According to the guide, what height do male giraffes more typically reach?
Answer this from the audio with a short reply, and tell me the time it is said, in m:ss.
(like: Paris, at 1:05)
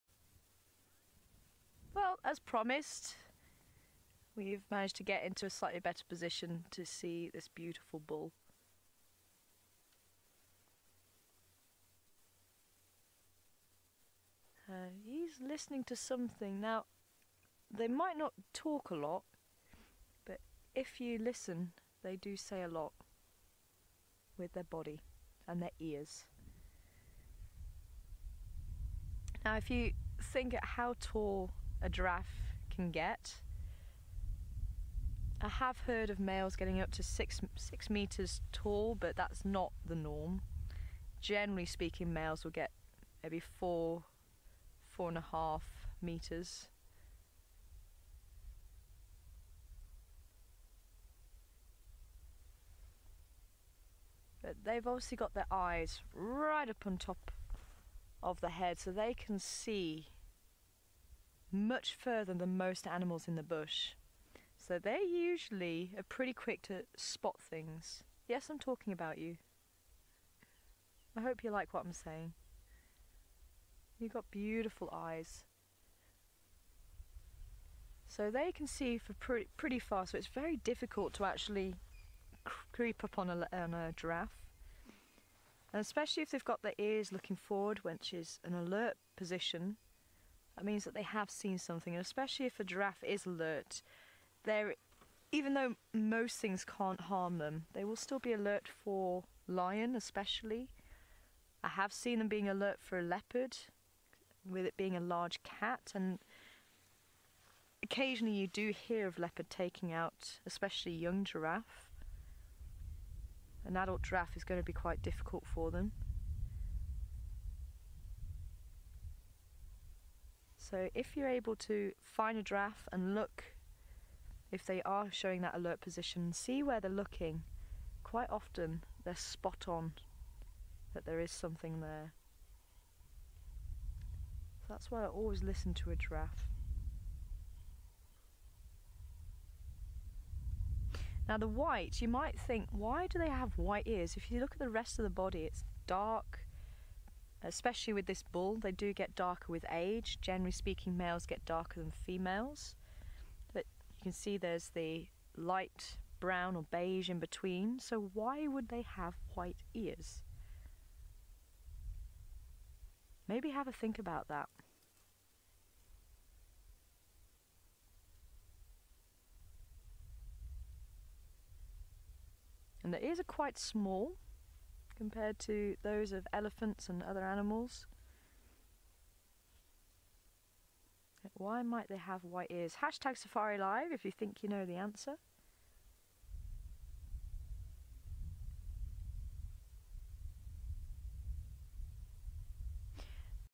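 4 to 4.5 meters, at 0:43.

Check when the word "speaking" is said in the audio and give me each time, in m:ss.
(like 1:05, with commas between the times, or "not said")
0:41, 2:30.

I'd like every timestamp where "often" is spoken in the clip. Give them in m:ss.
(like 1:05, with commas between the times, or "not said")
2:08.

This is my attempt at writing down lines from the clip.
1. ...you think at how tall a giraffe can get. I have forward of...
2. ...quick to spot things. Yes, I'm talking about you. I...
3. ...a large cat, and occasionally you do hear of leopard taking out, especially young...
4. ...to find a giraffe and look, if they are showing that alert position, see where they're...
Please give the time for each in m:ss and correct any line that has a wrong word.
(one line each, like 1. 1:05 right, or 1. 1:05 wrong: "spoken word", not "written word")
1. 0:29 wrong: "heard", not "forward"
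2. 1:06 right
3. 1:44 right
4. 2:01 right.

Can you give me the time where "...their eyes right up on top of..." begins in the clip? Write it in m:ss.
0:55.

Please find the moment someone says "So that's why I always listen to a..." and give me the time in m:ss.
2:14.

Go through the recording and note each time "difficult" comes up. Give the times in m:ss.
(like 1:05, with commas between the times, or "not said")
1:20, 1:55.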